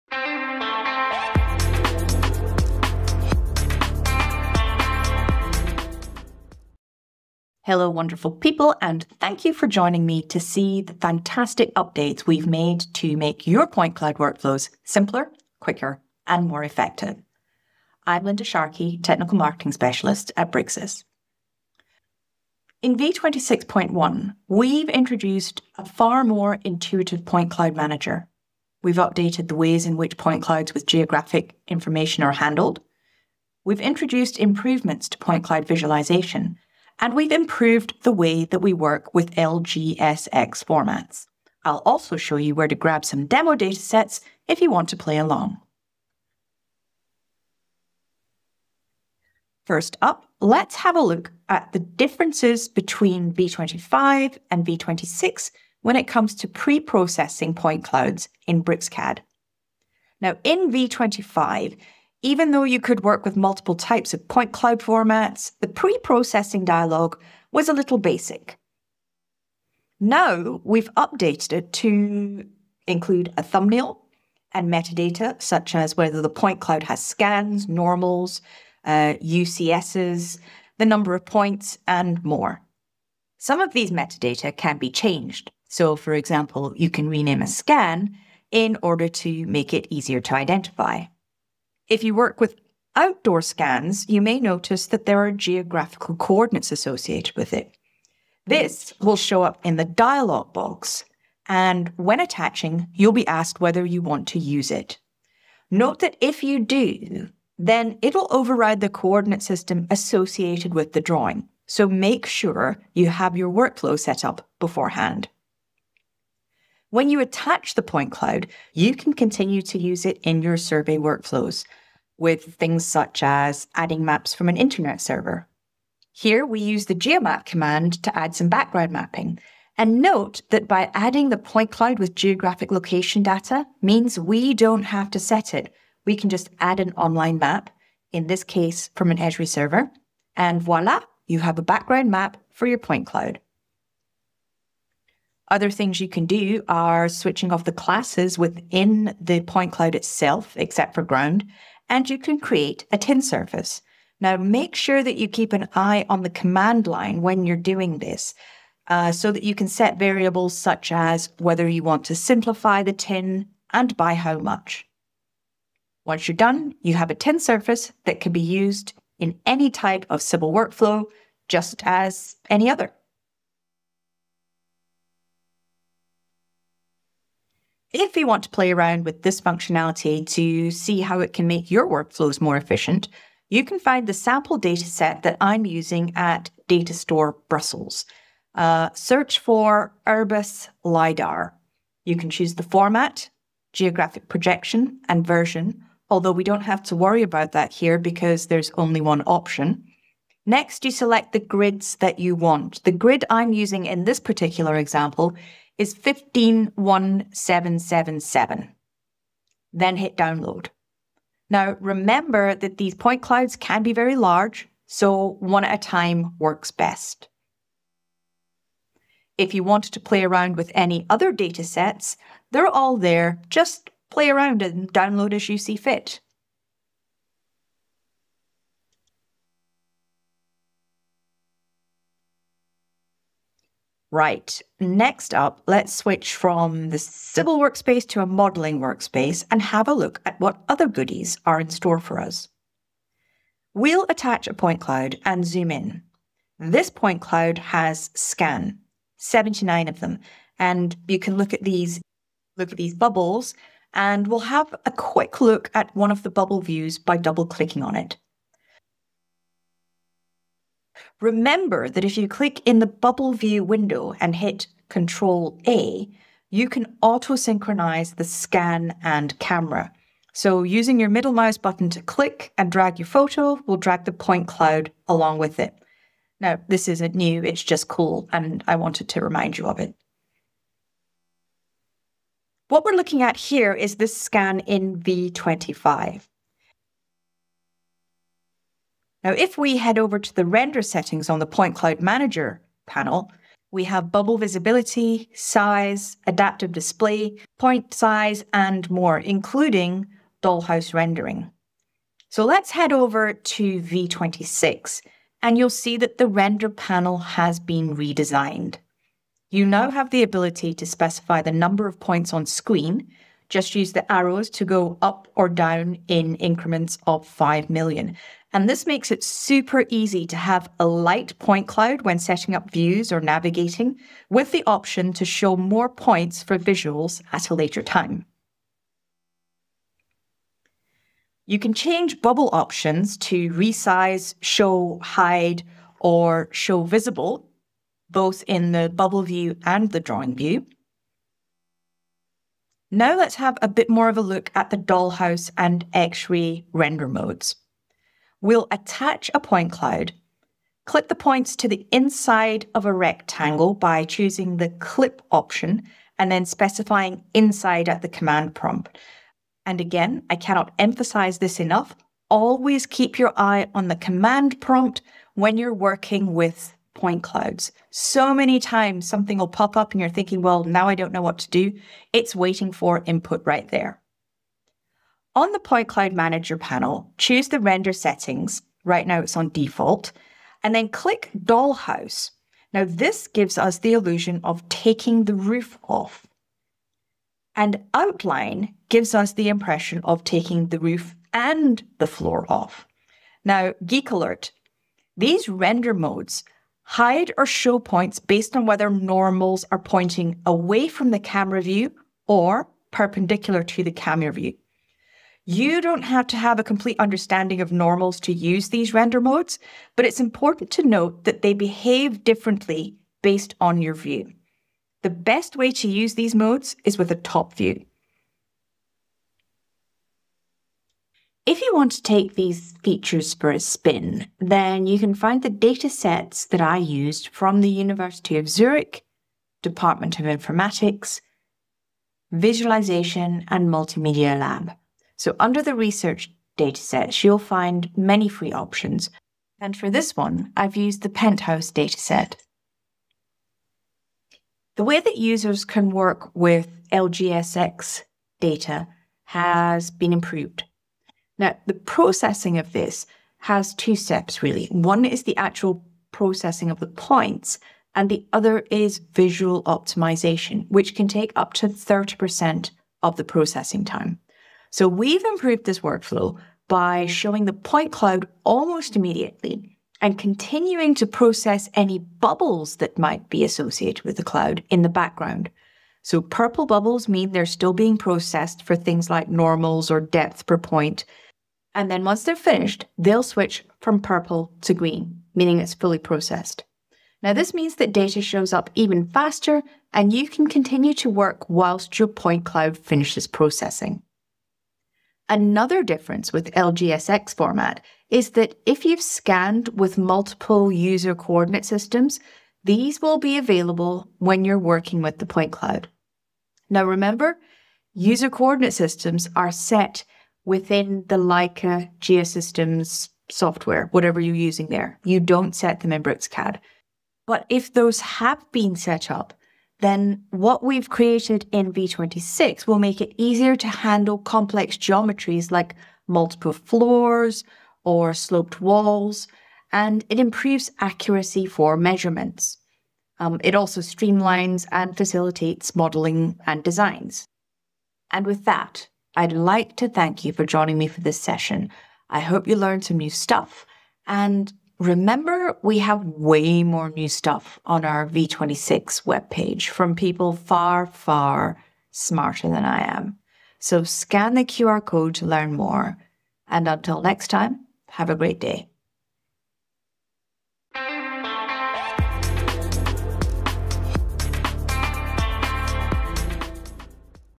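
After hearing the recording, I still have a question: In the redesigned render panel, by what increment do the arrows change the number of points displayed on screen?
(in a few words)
5 million.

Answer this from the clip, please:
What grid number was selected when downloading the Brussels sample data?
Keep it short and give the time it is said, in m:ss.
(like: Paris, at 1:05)
151777, at 3:25.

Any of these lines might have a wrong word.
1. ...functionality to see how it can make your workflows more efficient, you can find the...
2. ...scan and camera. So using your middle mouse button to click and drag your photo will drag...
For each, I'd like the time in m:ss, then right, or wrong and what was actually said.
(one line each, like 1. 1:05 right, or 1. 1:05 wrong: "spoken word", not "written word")
1. 2:59 right
2. 4:28 right.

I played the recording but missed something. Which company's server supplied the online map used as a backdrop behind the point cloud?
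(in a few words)
Esri.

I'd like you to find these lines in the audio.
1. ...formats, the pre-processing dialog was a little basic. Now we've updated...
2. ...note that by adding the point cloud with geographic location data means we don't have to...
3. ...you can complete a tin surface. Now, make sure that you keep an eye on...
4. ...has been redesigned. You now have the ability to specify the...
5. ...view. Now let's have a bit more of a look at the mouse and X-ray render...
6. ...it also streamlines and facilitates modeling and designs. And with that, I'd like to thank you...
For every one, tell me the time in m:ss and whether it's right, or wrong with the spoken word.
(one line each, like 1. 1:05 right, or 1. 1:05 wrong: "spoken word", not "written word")
1. 1:04 right
2. 2:10 right
3. 2:32 wrong: "create", not "complete"
4. 5:07 right
5. 5:40 wrong: "dollhouse", not "mouse"
6. 8:53 right.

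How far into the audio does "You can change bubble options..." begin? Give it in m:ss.
5:31.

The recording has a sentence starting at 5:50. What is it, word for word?
Clip the points to the inside of a rectangle by choosing the clip option and then specifying inside at the command prompt.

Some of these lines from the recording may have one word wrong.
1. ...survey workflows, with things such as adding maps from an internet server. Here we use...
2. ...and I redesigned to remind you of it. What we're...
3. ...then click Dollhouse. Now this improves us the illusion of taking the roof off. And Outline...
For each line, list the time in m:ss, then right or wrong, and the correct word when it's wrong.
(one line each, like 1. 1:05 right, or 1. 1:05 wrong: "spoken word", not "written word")
1. 2:00 right
2. 4:38 wrong: "wanted", not "redesigned"
3. 6:20 wrong: "gives", not "improves".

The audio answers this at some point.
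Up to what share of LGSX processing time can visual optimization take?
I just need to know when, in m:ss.
7:41.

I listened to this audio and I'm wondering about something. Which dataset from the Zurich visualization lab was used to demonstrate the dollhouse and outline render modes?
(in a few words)
Penthouse.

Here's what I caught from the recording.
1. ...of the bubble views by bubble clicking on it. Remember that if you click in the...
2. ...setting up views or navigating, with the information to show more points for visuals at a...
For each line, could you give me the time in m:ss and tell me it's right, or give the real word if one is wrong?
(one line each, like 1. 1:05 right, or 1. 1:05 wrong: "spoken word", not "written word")
1. 4:16 wrong: "double", not "bubble"
2. 5:22 wrong: "option", not "information".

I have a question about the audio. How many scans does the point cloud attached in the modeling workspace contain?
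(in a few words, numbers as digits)
79.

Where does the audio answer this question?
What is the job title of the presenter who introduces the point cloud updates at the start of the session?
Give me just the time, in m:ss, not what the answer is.
0:18.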